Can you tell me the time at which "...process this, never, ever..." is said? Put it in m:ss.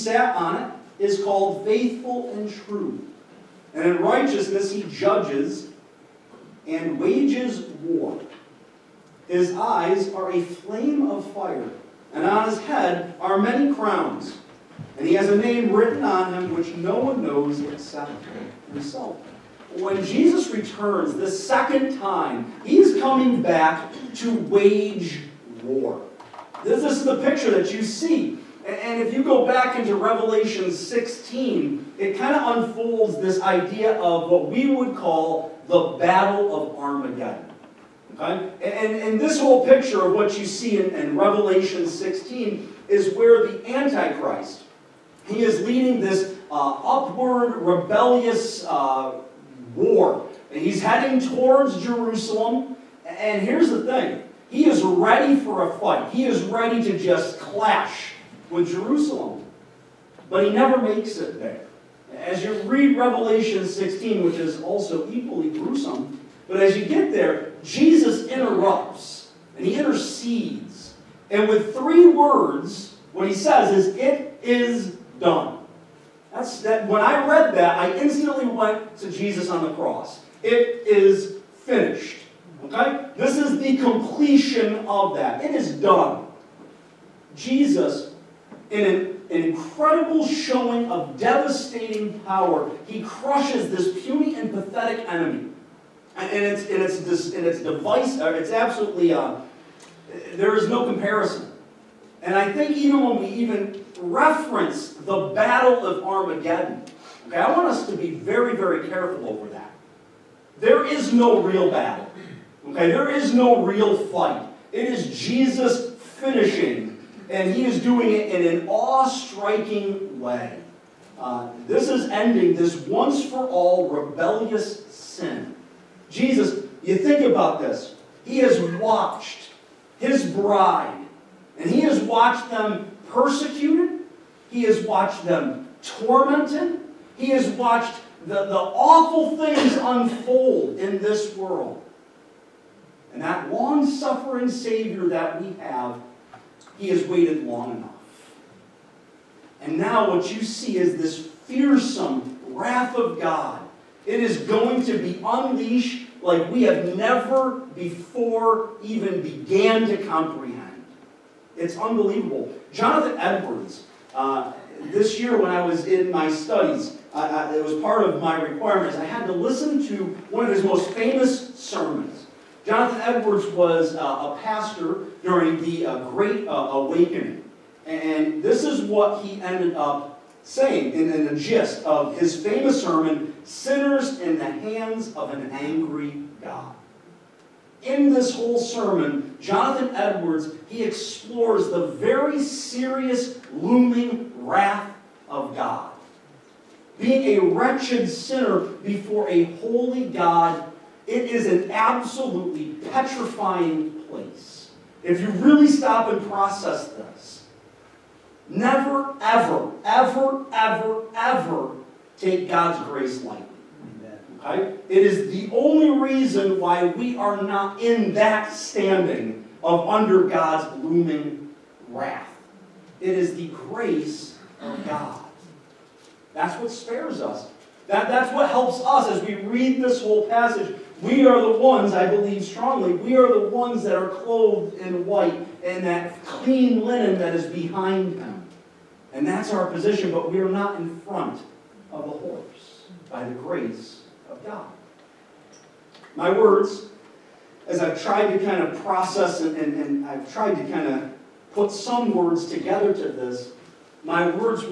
3:26.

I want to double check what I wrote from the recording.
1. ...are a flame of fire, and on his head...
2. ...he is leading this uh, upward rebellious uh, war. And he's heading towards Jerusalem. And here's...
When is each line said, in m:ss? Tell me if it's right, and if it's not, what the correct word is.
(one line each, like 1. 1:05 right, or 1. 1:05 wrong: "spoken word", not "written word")
1. 0:10 right
2. 0:45 right.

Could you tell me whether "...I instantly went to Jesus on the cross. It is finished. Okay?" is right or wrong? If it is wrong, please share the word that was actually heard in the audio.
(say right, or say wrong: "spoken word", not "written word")
right.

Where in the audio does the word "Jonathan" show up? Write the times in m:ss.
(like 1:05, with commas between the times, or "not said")
2:42, 2:52, 3:09.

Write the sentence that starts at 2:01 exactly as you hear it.
Uh, this is ending this once-for-all rebellious sin.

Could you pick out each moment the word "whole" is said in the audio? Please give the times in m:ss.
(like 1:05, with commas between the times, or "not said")
0:39, 3:08, 3:50.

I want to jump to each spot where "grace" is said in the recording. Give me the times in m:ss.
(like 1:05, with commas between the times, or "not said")
3:32, 3:43, 4:03.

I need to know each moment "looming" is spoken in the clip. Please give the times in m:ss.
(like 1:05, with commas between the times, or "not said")
3:13, 3:40.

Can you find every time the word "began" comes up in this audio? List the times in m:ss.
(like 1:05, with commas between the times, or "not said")
2:39.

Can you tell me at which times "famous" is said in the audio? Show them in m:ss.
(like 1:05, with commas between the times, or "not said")
2:50, 3:02.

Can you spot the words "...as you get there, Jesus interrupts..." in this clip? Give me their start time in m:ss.
1:06.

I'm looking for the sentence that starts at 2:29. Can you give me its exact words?
And now what you see is this fearsome wrath of God.